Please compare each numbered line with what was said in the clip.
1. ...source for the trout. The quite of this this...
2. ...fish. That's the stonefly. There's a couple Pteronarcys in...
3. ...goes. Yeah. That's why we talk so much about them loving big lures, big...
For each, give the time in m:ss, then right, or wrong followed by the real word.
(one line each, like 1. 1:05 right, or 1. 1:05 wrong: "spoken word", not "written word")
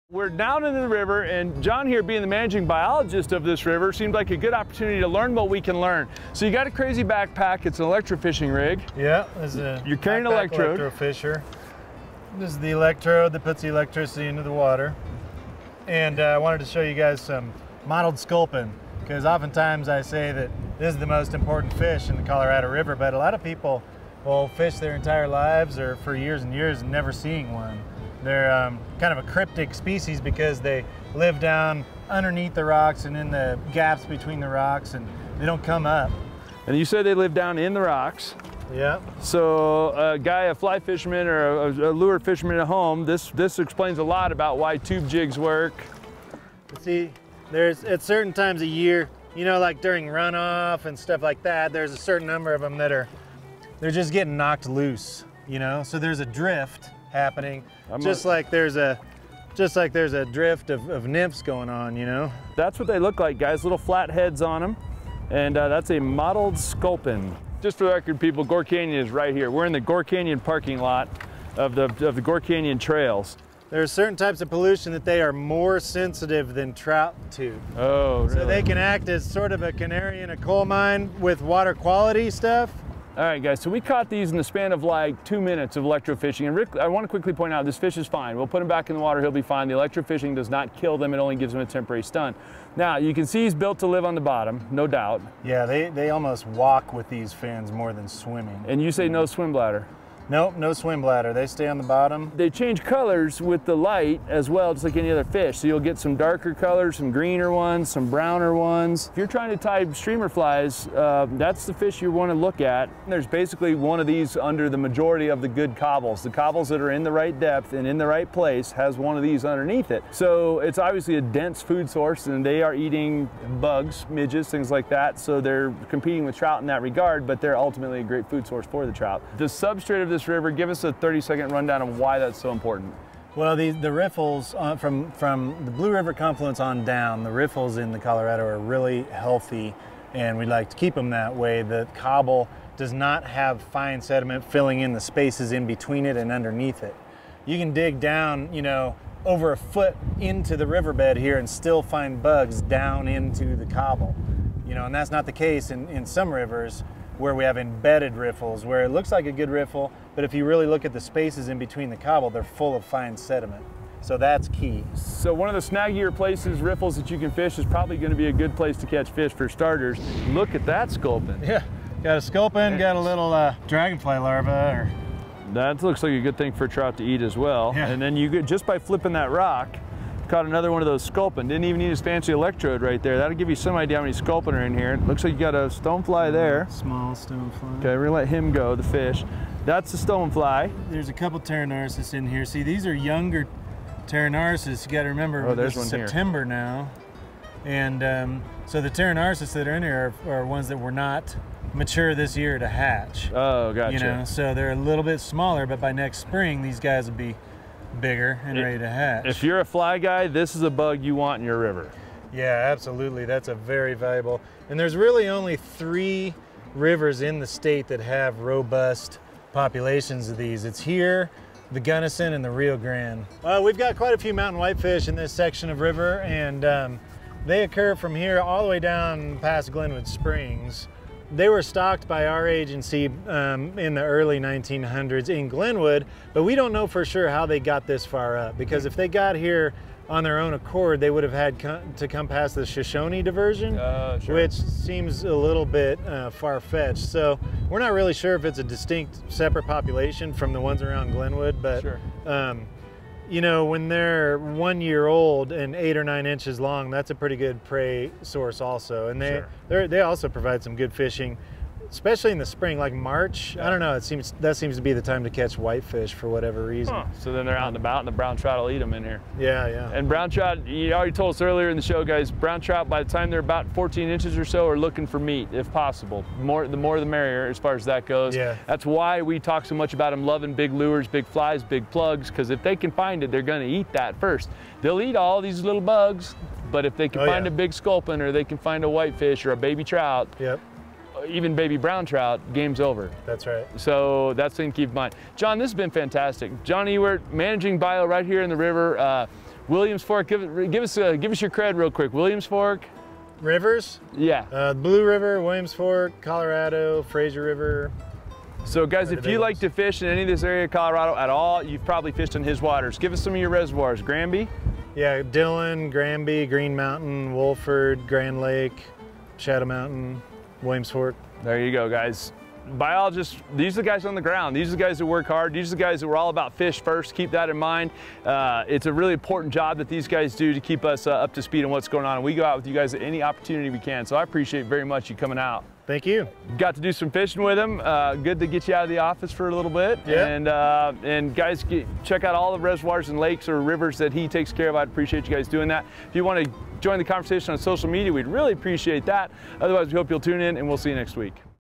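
1. 2:08 wrong: "substrate", not "quite"
2. 3:08 right
3. 4:38 right.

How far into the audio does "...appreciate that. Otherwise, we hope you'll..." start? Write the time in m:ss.
5:48.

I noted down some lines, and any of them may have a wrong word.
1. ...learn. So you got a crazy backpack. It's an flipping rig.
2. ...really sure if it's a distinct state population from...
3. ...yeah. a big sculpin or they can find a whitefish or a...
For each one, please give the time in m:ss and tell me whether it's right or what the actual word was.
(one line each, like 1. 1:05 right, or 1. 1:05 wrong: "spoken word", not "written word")
1. 0:05 wrong: "electrofishing", not "flipping"
2. 4:07 wrong: "separate", not "state"
3. 4:47 right.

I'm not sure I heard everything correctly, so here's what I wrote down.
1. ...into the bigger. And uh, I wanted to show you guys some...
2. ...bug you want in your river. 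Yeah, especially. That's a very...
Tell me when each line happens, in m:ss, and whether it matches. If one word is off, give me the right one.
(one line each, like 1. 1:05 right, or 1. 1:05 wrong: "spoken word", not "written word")
1. 0:14 wrong: "water", not "bigger"
2. 3:30 wrong: "absolutely", not "especially".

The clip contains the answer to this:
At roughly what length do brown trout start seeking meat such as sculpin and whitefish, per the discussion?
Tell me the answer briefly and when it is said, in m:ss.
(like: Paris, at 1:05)
14 inches, at 4:33.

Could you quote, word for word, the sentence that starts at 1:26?
And Rick, I want to quickly point out this fish is fine.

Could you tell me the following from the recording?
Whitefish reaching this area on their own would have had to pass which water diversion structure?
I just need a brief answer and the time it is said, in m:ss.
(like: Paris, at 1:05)
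Shoshone diversion, at 4:02.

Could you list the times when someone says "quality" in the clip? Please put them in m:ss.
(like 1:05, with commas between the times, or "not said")
1:21.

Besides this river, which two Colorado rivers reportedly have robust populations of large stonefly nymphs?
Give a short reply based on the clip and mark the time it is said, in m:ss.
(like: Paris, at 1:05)
the Gunnison and the Rio Grande, at 3:41.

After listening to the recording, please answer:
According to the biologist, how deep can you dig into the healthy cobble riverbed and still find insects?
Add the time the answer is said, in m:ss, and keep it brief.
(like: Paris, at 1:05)
over a foot, at 2:29.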